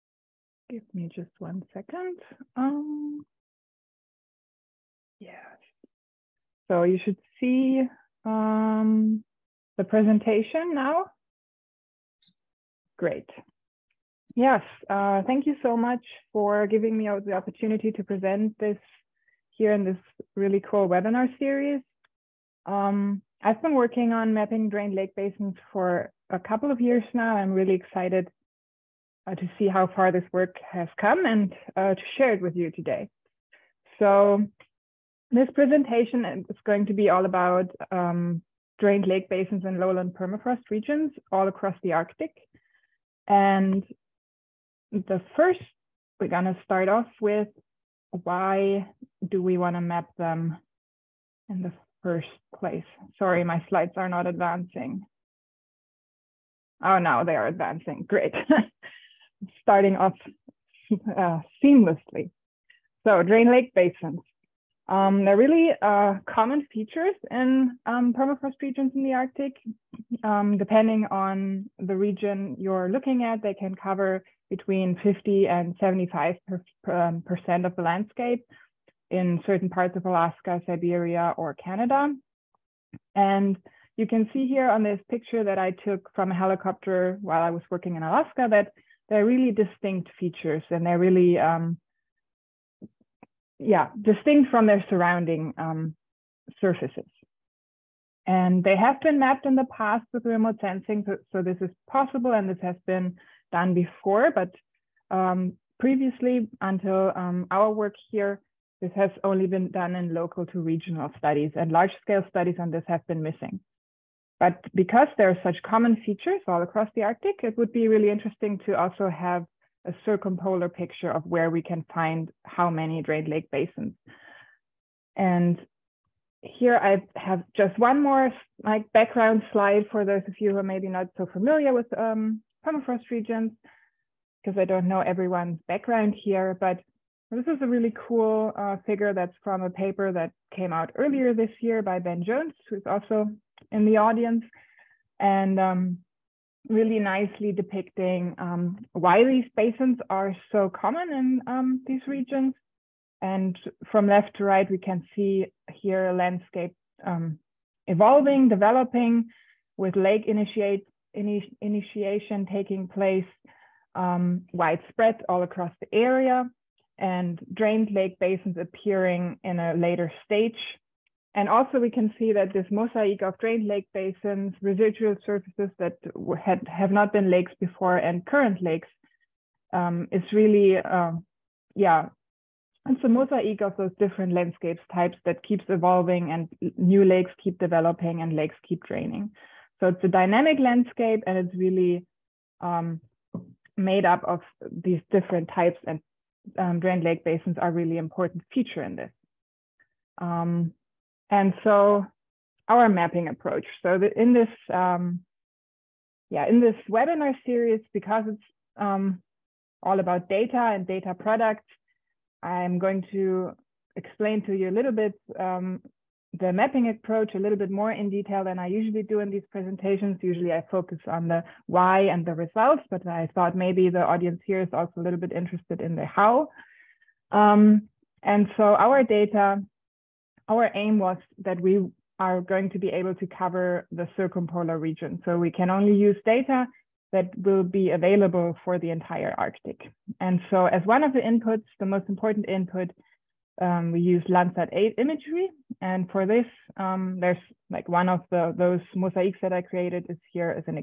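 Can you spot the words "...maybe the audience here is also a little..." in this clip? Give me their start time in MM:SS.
03:43.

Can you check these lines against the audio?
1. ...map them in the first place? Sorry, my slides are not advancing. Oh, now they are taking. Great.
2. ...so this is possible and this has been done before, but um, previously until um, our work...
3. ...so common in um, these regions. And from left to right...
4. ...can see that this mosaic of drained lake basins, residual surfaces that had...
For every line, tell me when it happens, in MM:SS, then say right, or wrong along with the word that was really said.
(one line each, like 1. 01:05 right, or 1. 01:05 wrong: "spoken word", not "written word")
1. 00:49 wrong: "advancing", not "taking"
2. 01:41 right
3. 02:30 right
4. 02:51 right.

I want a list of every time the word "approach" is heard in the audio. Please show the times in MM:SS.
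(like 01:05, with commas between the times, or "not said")
03:23, 03:36.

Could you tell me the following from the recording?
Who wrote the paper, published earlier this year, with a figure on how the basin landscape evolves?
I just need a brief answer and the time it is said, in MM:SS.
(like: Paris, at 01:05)
Ben Jones, at 02:21.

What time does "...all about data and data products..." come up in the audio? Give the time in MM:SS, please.
03:29.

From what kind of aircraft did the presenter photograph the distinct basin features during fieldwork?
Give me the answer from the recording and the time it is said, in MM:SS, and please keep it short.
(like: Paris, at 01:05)
Helicopter, at 01:26.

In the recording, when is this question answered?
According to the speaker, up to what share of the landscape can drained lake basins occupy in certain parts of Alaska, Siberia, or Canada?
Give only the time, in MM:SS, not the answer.
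01:14.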